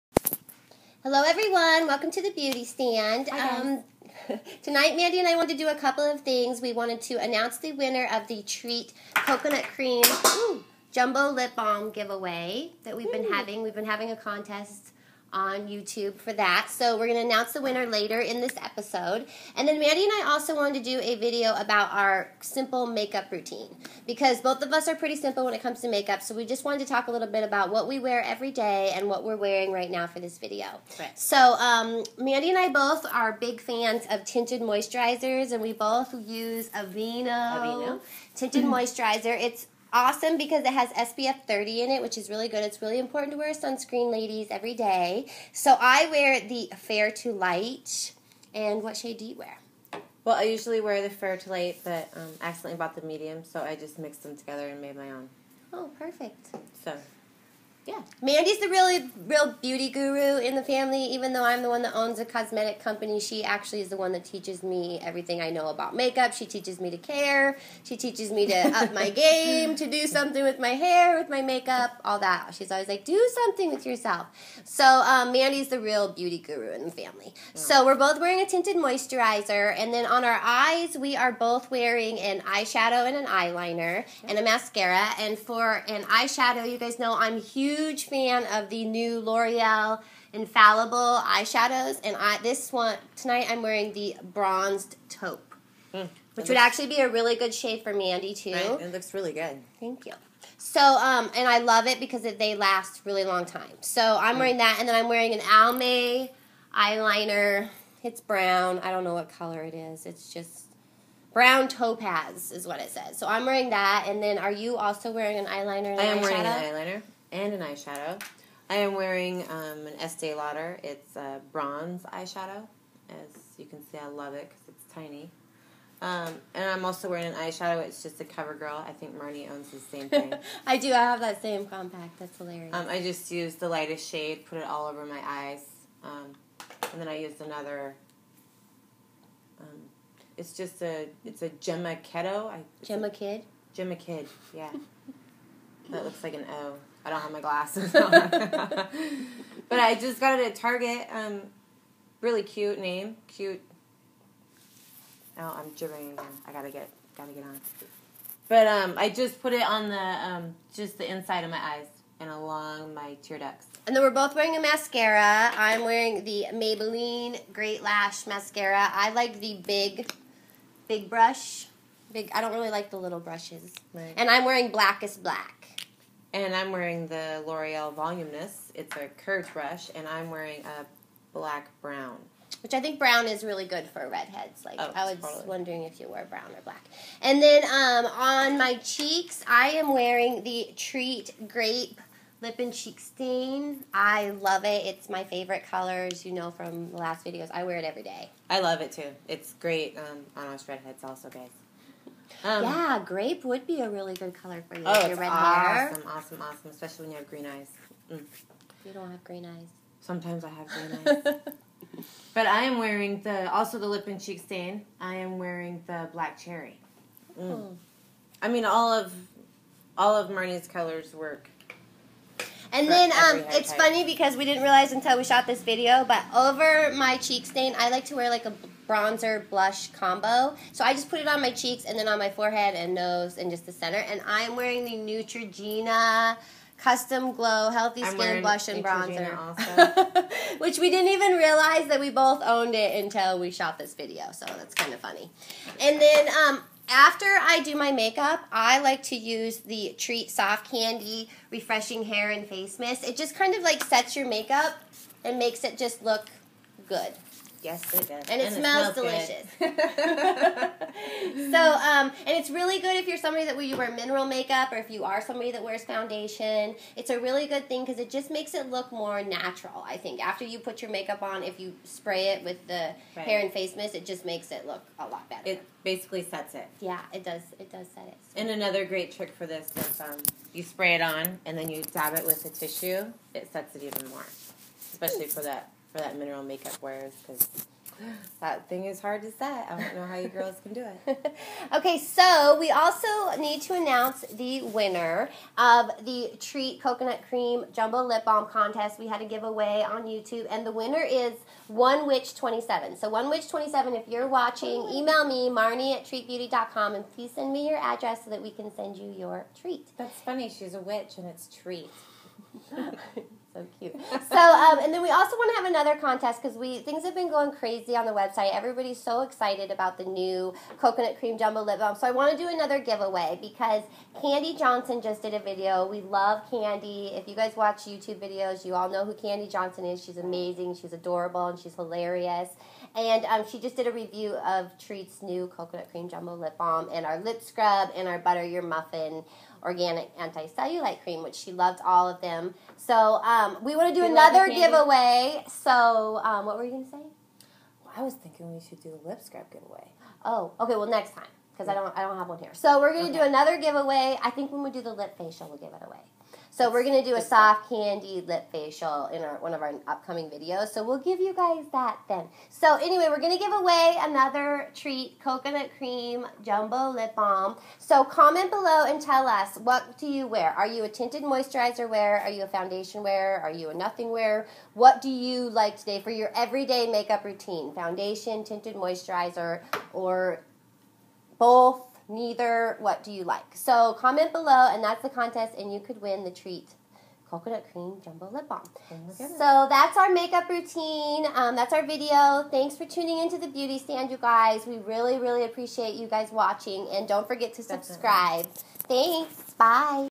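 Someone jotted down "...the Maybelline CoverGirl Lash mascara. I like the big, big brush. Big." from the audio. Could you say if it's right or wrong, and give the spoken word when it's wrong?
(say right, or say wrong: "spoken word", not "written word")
wrong: "Great", not "CoverGirl".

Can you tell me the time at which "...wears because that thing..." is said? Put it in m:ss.
4:46.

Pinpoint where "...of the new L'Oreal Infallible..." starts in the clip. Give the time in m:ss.
1:28.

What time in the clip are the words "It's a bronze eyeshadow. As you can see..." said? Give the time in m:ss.
2:00.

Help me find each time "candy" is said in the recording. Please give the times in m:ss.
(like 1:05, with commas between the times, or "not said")
4:10, 5:57.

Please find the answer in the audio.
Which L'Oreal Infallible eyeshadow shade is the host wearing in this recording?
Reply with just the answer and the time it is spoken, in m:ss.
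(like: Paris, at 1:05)
bronzed taupe, at 1:34.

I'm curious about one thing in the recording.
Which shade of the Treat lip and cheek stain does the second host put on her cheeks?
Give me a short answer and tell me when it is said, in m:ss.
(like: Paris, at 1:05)
black cherry, at 3:36.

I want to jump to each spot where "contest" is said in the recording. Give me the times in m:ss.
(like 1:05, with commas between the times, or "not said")
0:14, 4:58, 5:15, 6:25.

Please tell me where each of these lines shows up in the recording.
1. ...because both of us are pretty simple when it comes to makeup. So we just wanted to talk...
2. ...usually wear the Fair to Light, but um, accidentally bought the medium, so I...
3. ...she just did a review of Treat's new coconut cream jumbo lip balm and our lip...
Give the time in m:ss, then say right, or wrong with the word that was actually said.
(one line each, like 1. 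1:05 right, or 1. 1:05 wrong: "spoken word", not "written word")
1. 0:24 right
2. 0:50 right
3. 5:33 right.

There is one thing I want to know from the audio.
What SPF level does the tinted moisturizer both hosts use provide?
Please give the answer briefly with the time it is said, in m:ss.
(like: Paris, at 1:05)
SPF 30, at 0:40.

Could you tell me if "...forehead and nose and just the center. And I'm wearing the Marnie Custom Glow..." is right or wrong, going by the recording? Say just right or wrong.
wrong.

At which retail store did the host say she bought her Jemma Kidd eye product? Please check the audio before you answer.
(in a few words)
Target.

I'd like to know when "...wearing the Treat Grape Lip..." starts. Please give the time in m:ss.
3:09.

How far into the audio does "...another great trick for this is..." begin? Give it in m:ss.
4:38.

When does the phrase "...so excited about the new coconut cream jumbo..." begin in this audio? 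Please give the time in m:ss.
5:19.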